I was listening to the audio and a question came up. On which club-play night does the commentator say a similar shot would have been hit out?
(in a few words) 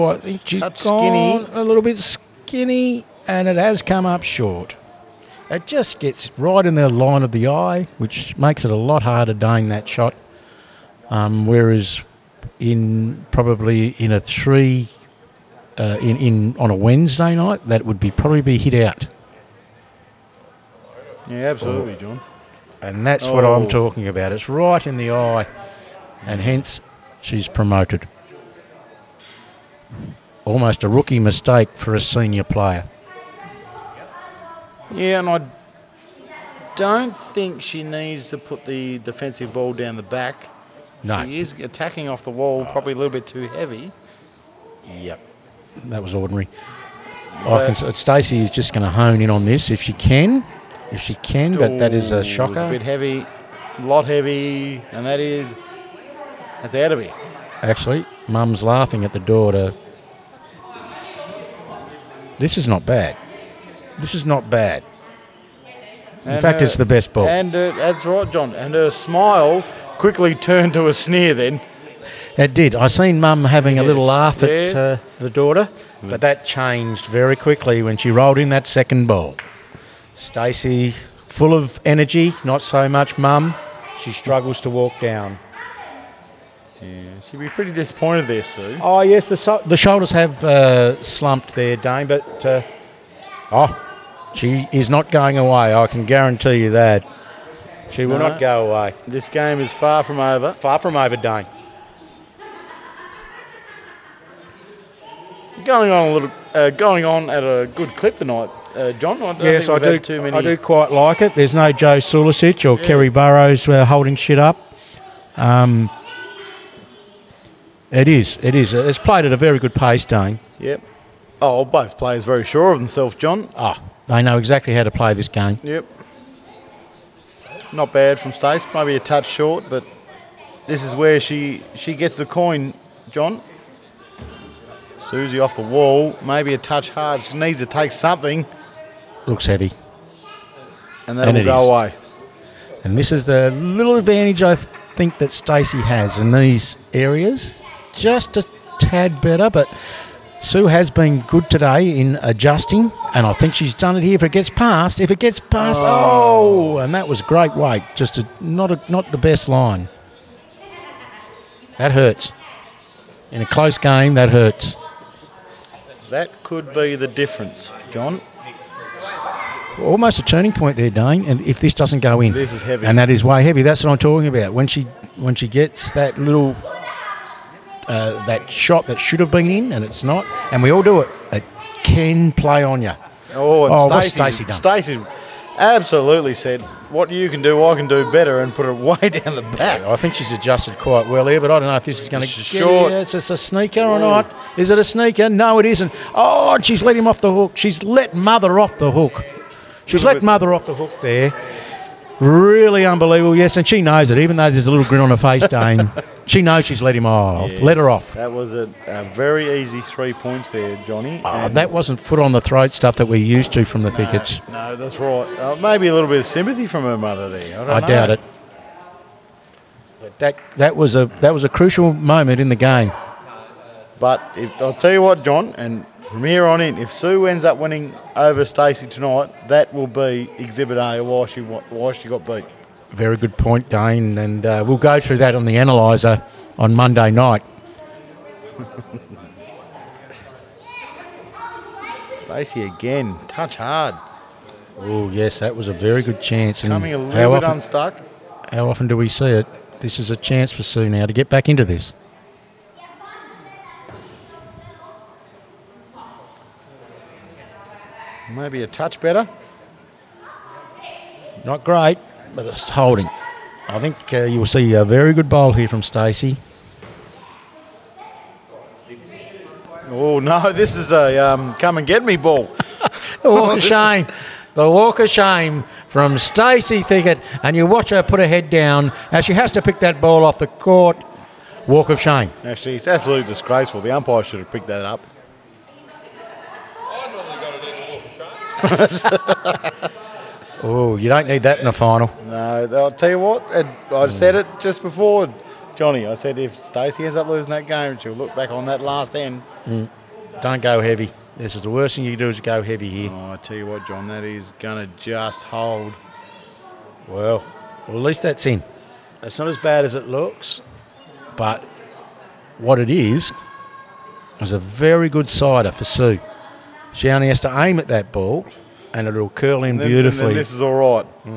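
Wednesday.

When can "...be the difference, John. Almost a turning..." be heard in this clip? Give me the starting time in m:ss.
2:46.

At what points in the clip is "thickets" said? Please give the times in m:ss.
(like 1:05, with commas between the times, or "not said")
3:33, 4:36.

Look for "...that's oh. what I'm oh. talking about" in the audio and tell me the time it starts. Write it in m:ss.
0:23.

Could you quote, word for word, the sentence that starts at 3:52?
Very good point, Dane, and uh, we'll go through that on the analyzer on Monday night.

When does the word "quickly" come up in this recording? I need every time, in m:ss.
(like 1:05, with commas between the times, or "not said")
1:10, 1:17.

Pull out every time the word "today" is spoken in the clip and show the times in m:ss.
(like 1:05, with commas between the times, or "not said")
2:31.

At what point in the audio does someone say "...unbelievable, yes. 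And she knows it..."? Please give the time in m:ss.
3:22.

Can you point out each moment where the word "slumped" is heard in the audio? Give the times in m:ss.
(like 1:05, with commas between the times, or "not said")
1:31.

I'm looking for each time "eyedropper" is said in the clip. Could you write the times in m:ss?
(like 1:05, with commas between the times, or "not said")
not said.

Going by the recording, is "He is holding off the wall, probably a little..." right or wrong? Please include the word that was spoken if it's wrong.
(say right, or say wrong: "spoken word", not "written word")
wrong: "attacking", not "holding".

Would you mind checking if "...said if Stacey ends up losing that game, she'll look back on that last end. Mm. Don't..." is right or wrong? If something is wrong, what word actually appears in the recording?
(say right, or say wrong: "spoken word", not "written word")
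right.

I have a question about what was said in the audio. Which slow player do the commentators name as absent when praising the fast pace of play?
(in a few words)
Kerry Burrows.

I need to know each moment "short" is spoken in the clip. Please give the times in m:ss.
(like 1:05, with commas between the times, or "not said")
0:04, 2:09, 3:12.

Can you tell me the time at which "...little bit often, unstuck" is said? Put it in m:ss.
4:06.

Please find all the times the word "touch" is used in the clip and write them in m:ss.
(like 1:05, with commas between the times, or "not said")
2:09, 2:16, 4:03, 4:18.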